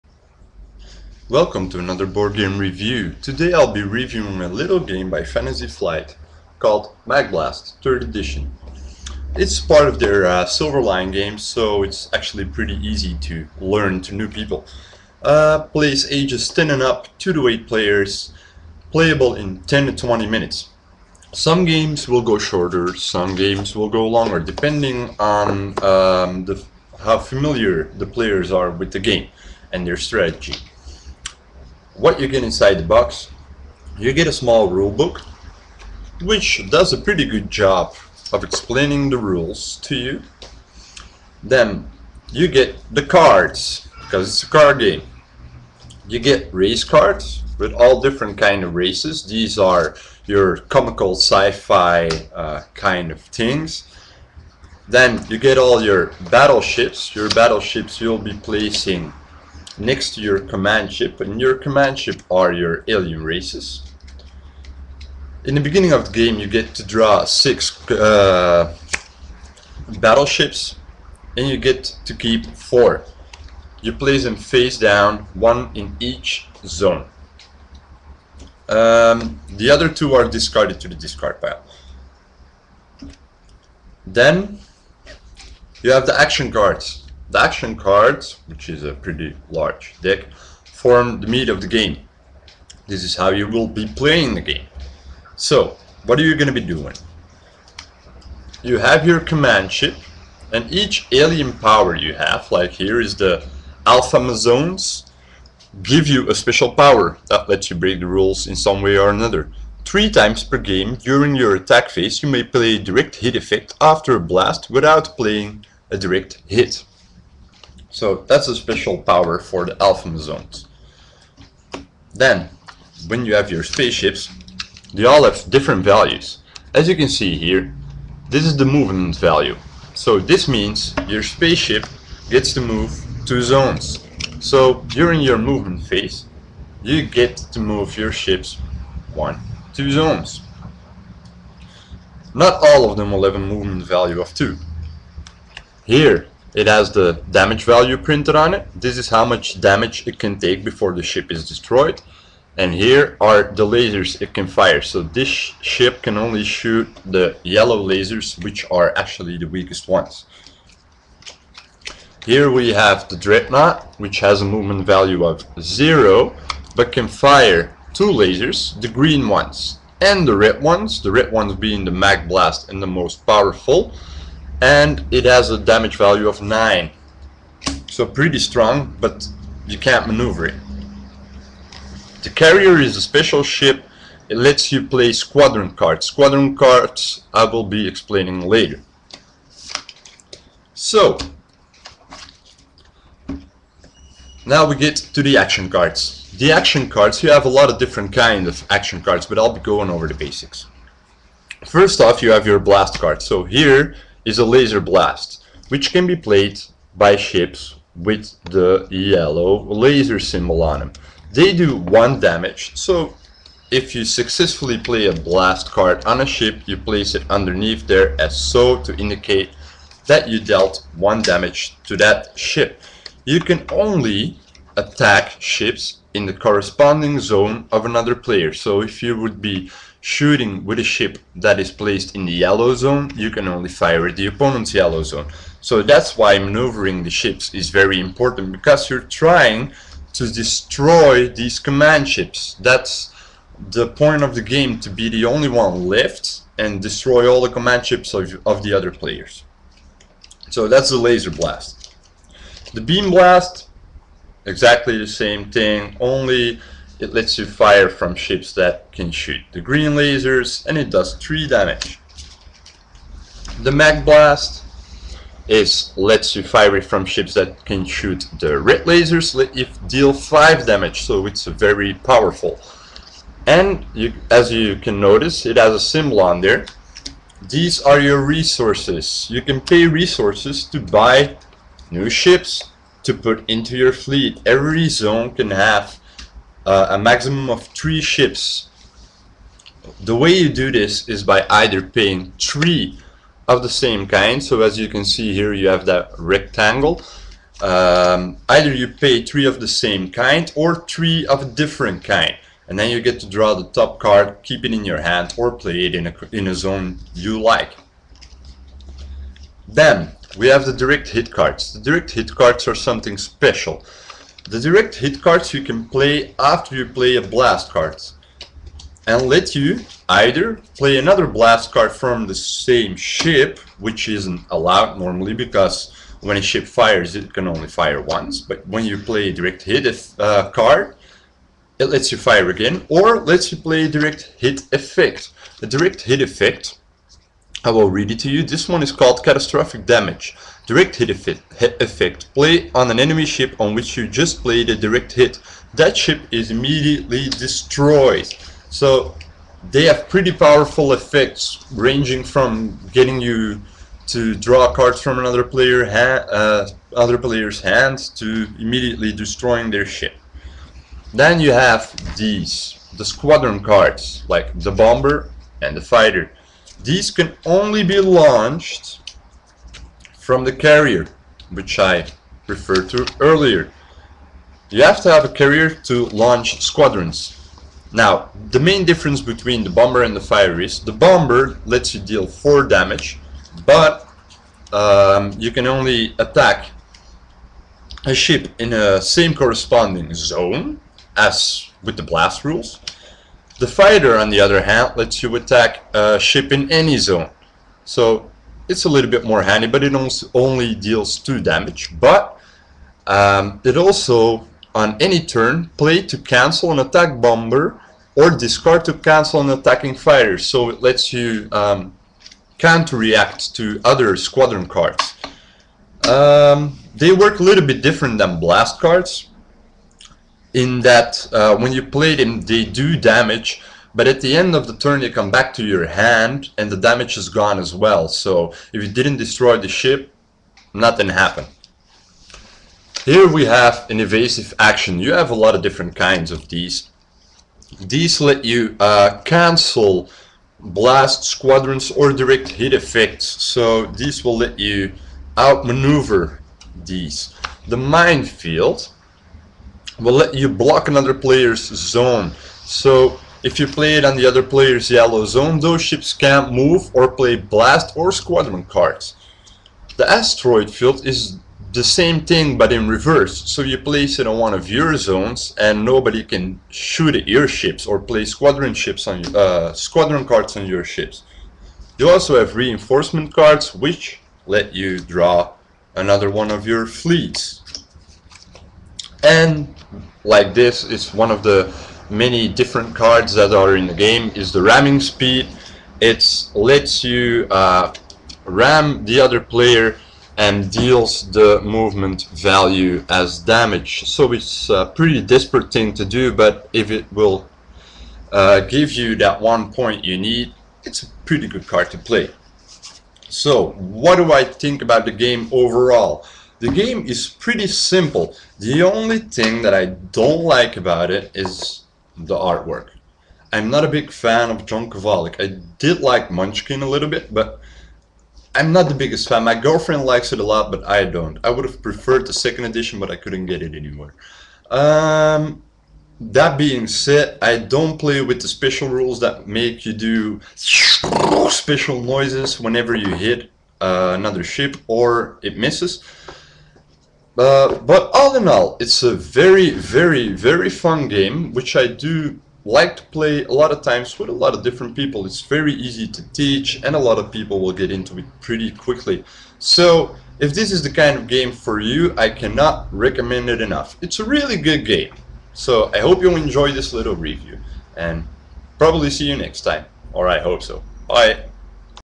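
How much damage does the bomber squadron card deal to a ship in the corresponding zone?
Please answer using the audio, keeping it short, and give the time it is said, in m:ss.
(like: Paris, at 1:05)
4, at 6:22.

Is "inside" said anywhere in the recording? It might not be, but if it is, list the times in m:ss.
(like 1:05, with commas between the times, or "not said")
0:32.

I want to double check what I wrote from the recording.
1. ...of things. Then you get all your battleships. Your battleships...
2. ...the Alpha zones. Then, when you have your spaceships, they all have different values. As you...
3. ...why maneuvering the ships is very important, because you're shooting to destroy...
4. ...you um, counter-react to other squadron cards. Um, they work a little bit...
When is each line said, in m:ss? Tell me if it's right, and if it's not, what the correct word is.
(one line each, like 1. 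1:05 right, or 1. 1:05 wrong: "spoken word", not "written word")
1. 0:53 right
2. 1:59 right
3. 3:56 wrong: "trying", not "shooting"
4. 6:51 right.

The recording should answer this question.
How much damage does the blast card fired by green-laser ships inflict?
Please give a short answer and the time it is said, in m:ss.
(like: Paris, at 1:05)
3, at 4:21.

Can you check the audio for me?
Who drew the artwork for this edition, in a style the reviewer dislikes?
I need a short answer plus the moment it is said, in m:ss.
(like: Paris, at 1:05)
John Kovalic, at 8:34.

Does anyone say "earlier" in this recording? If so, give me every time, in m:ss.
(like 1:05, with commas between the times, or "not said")
6:13.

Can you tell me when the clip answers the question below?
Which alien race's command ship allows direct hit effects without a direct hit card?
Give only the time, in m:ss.
1:43.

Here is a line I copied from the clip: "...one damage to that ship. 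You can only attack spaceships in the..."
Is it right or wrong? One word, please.
wrong.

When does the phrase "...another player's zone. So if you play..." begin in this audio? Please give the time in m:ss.
7:30.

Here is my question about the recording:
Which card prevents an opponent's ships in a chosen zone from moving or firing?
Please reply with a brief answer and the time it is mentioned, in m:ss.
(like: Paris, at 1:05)
minefield, at 7:27.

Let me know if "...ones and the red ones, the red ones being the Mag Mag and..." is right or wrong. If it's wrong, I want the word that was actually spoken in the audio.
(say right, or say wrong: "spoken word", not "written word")
wrong: "Blast", not "Mag".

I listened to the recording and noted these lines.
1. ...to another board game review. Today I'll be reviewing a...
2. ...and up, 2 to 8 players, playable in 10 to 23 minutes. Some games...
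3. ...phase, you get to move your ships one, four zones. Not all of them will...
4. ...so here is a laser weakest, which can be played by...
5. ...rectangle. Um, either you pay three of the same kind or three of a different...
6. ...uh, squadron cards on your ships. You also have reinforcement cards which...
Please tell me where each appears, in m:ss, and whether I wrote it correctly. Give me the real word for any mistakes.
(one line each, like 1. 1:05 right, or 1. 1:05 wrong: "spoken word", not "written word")
1. 0:01 right
2. 0:16 wrong: "20", not "23"
3. 2:15 wrong: "two", not "four"
4. 3:23 wrong: "blast", not "weakest"
5. 4:56 right
6. 7:49 right.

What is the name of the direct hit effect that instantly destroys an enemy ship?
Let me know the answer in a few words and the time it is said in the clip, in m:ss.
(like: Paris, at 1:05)
Catastrophic Damage, at 5:39.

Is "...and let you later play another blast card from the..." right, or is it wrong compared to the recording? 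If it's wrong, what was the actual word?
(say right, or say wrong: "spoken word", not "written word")
wrong: "either", not "later".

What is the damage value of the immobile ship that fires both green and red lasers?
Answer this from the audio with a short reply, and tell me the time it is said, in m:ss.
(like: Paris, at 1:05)
9, at 2:56.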